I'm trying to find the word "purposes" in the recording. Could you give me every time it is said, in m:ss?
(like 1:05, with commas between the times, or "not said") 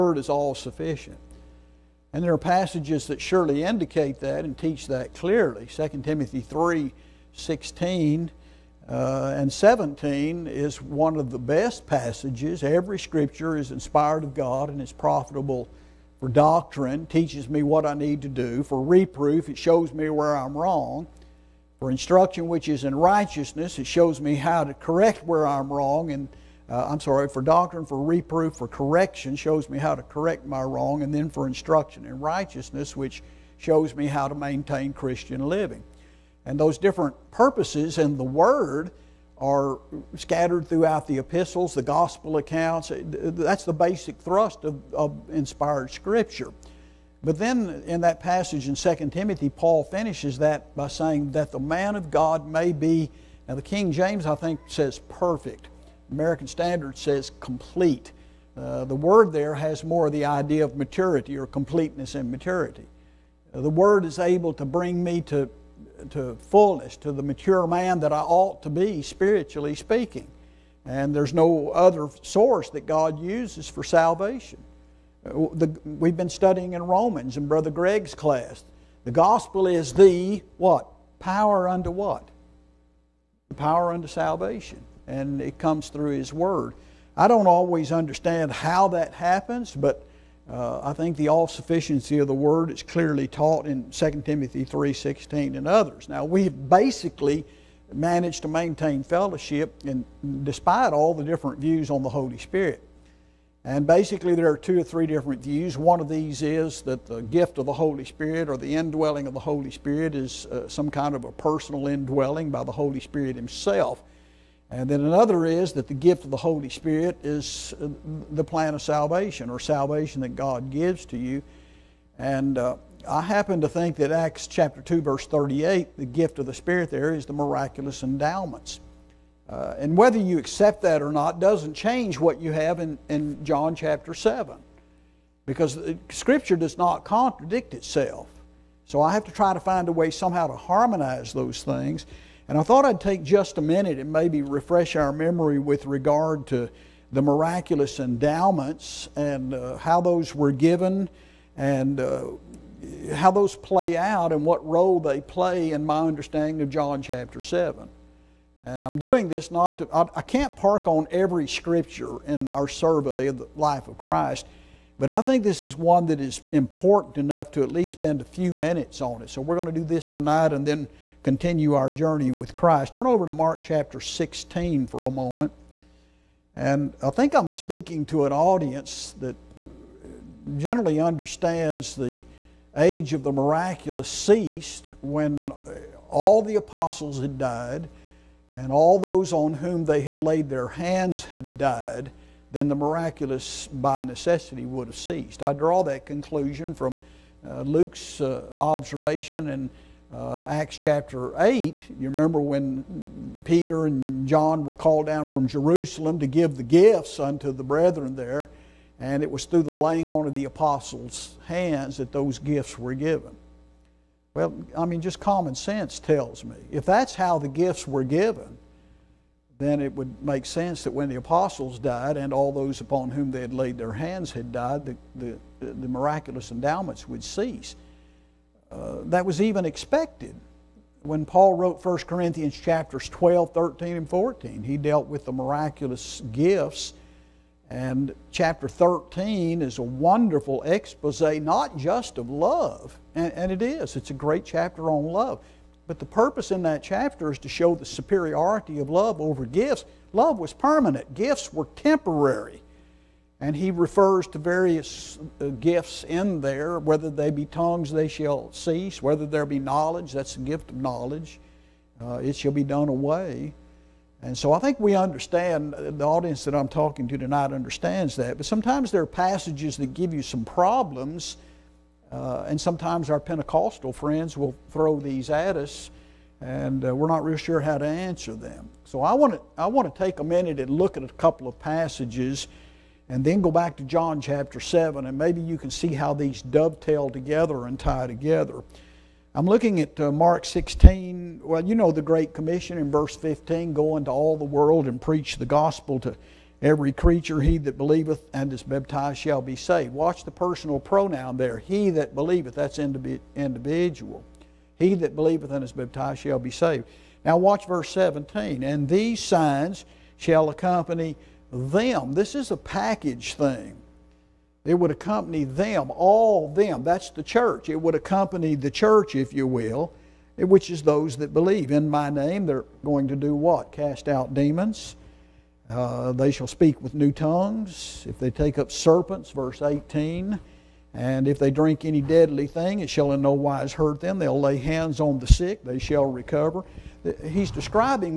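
0:37, 4:06.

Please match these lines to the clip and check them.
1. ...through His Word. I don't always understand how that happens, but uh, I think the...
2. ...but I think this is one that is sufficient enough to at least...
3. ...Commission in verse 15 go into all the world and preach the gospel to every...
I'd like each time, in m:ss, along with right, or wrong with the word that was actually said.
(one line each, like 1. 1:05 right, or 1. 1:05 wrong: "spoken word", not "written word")
1. 1:25 right
2. 2:44 wrong: "important", not "sufficient"
3. 4:52 right.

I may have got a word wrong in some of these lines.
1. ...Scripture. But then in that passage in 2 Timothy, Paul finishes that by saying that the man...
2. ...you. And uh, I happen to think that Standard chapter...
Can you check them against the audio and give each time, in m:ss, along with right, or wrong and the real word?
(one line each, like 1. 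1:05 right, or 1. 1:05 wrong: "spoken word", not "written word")
1. 0:45 right
2. 2:01 wrong: "Acts", not "Standard".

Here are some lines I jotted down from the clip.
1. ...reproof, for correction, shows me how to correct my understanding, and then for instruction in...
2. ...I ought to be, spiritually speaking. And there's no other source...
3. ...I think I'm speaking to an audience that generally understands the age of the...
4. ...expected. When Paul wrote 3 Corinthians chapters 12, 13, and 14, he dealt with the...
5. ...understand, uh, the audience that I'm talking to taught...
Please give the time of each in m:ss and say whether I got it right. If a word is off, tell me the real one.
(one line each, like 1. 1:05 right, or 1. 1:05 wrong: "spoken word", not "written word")
1. 0:28 wrong: "wrong", not "understanding"
2. 1:08 right
3. 2:57 right
4. 3:49 wrong: "1", not "3"
5. 4:24 wrong: "tonight", not "taught".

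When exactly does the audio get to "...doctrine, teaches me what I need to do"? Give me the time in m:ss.
0:16.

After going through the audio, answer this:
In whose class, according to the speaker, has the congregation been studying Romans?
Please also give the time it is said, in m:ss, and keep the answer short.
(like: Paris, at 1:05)
Brother Greg, at 1:17.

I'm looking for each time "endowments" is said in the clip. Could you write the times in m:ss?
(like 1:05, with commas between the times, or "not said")
2:08, 2:27, 3:46.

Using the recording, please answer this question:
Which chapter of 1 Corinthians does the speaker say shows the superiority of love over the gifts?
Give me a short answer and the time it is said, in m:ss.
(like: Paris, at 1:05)
Chapter 13, at 3:58.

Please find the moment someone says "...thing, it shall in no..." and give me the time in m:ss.
5:32.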